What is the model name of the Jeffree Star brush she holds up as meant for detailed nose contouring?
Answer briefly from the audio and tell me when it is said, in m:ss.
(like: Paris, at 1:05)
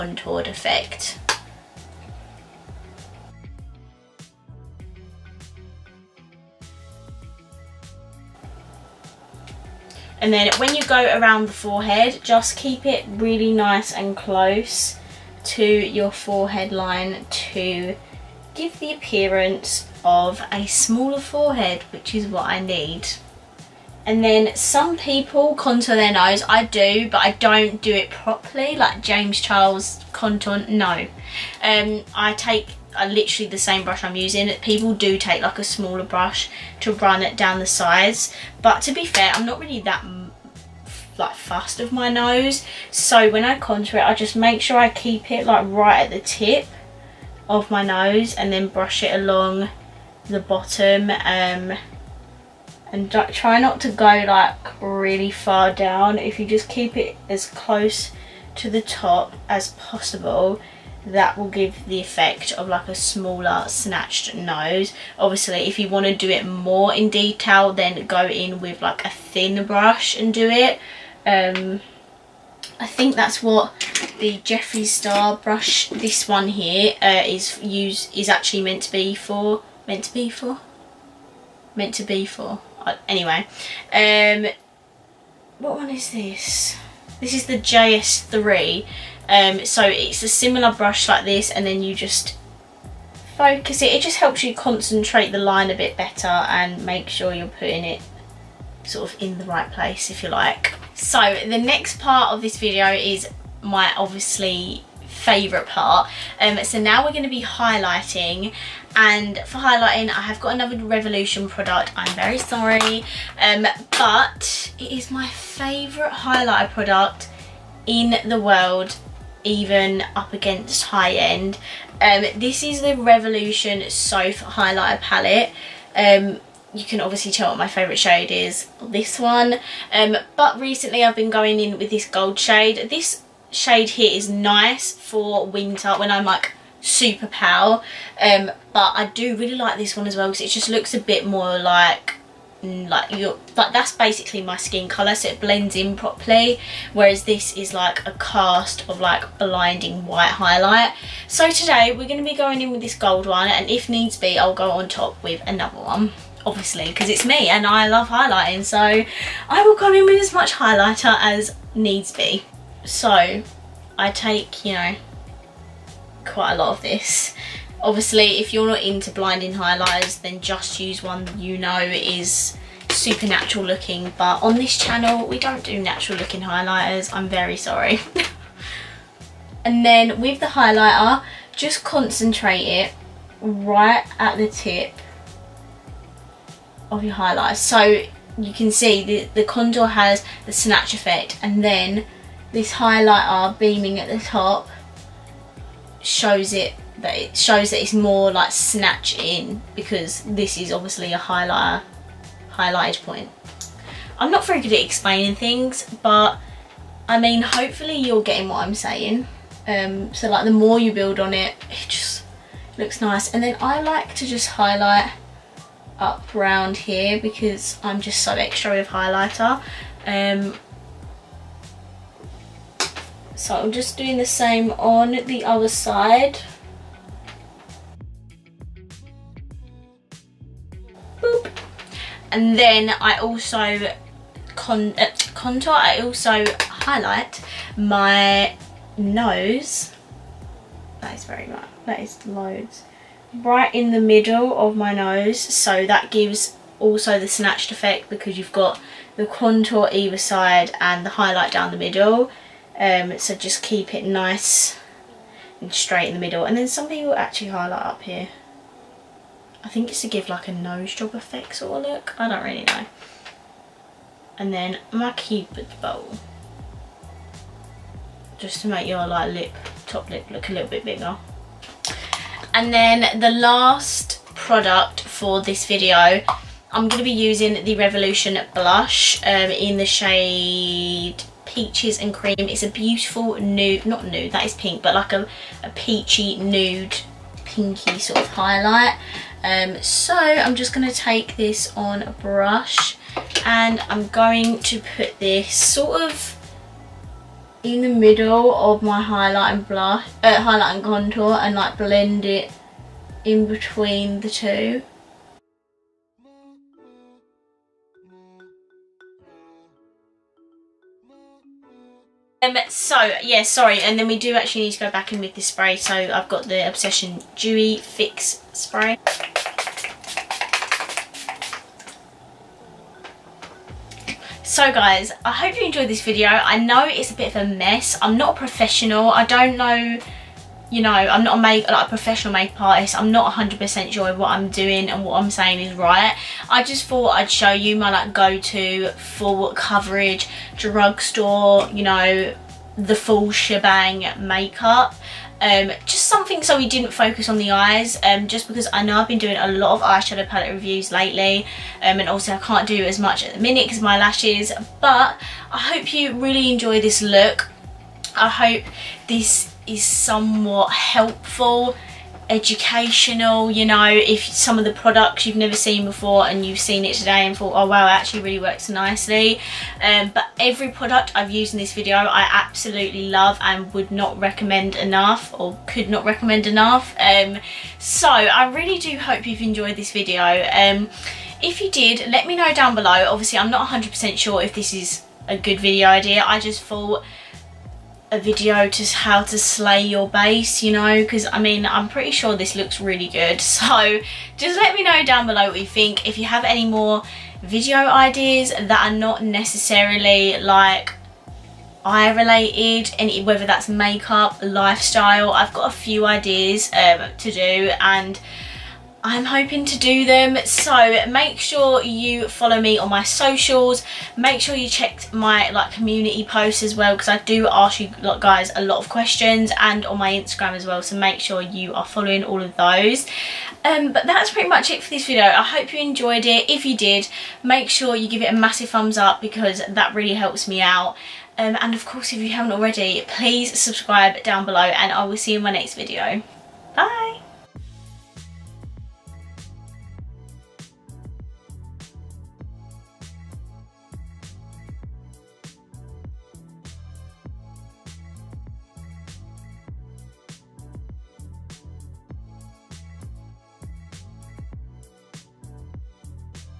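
JS3, at 1:27.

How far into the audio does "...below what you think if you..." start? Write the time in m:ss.
6:35.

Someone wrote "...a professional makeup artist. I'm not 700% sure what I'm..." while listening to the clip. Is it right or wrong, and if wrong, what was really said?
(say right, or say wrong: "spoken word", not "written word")
wrong: "100", not "700".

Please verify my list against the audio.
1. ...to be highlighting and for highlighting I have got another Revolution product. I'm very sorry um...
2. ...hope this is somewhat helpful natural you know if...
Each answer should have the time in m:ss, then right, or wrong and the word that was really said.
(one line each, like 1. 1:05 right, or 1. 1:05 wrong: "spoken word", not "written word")
1. 1:47 right
2. 5:58 wrong: "educational", not "natural".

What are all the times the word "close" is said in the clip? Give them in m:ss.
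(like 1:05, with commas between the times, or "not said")
0:14, 0:57.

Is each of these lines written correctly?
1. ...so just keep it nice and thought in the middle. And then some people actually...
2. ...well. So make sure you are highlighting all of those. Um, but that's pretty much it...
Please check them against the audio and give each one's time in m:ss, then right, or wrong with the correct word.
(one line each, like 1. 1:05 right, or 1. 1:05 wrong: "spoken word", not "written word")
1. 4:13 wrong: "straight", not "thought"
2. 7:00 wrong: "following", not "highlighting".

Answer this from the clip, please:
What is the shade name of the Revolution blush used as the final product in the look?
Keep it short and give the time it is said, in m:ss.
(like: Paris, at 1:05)
Peaches and Cream, at 4:41.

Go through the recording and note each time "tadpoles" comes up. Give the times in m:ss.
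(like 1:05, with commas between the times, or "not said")
not said.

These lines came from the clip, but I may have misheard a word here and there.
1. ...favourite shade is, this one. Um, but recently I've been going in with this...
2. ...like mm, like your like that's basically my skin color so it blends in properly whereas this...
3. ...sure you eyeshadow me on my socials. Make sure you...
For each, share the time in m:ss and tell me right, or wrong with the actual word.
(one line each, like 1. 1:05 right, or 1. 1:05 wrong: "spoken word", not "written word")
1. 2:07 right
2. 2:21 right
3. 6:51 wrong: "follow", not "eyeshadow".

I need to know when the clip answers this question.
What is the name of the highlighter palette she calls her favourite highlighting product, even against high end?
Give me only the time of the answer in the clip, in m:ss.
2:02.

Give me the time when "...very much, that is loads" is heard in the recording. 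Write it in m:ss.
4:01.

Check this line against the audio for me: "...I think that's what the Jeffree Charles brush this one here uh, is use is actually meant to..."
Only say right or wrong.
wrong.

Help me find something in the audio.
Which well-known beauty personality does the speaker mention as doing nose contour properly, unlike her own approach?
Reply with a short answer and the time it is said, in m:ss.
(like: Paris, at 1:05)
James Charles, at 0:29.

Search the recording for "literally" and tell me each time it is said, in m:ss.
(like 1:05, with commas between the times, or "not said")
0:33.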